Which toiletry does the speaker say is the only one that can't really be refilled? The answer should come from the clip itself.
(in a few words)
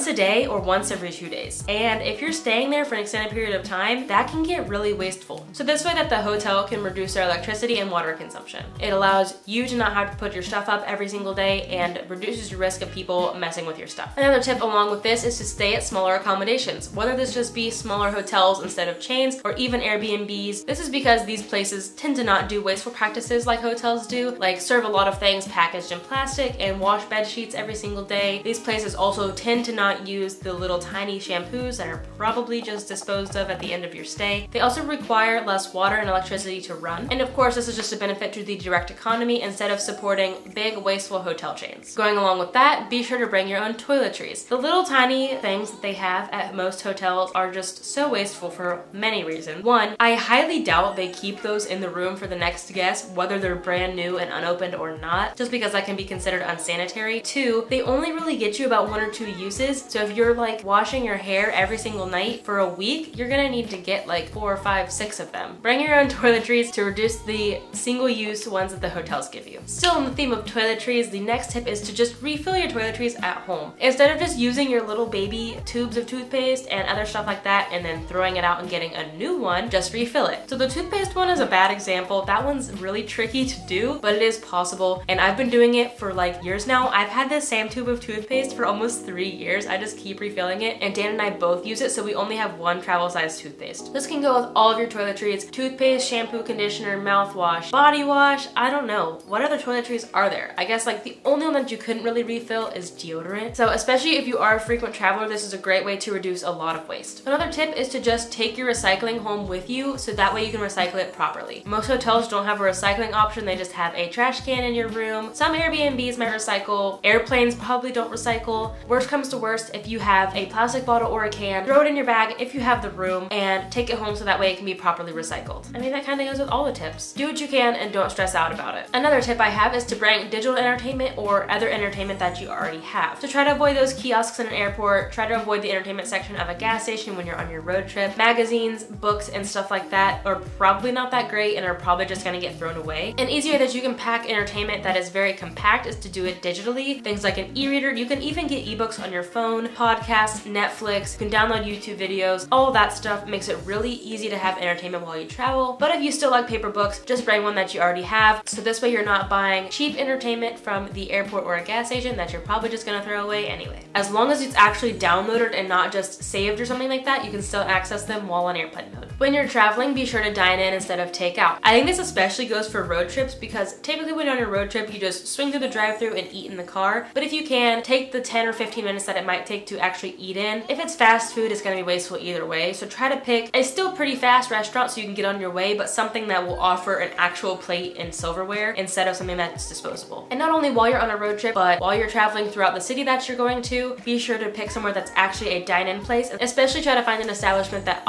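deodorant.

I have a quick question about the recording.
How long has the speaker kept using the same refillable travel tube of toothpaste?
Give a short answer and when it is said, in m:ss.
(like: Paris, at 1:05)
almost 3 years, at 1:28.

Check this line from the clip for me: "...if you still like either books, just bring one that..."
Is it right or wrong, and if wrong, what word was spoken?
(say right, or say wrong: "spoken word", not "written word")
wrong: "paper", not "either".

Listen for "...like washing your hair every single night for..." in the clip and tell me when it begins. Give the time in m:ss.
1:00.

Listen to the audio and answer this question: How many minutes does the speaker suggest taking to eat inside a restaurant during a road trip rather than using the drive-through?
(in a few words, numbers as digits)
10 or 15 minutes.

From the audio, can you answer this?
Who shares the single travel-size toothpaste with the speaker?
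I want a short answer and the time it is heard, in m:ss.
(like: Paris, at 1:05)
Dan, at 1:30.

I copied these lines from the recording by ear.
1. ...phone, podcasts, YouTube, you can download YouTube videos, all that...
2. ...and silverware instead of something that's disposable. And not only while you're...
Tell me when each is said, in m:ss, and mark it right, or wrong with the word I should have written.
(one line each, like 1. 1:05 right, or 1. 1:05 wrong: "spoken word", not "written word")
1. 2:29 wrong: "Netflix", not "YouTube"
2. 3:07 right.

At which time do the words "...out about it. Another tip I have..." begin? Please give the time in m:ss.
2:08.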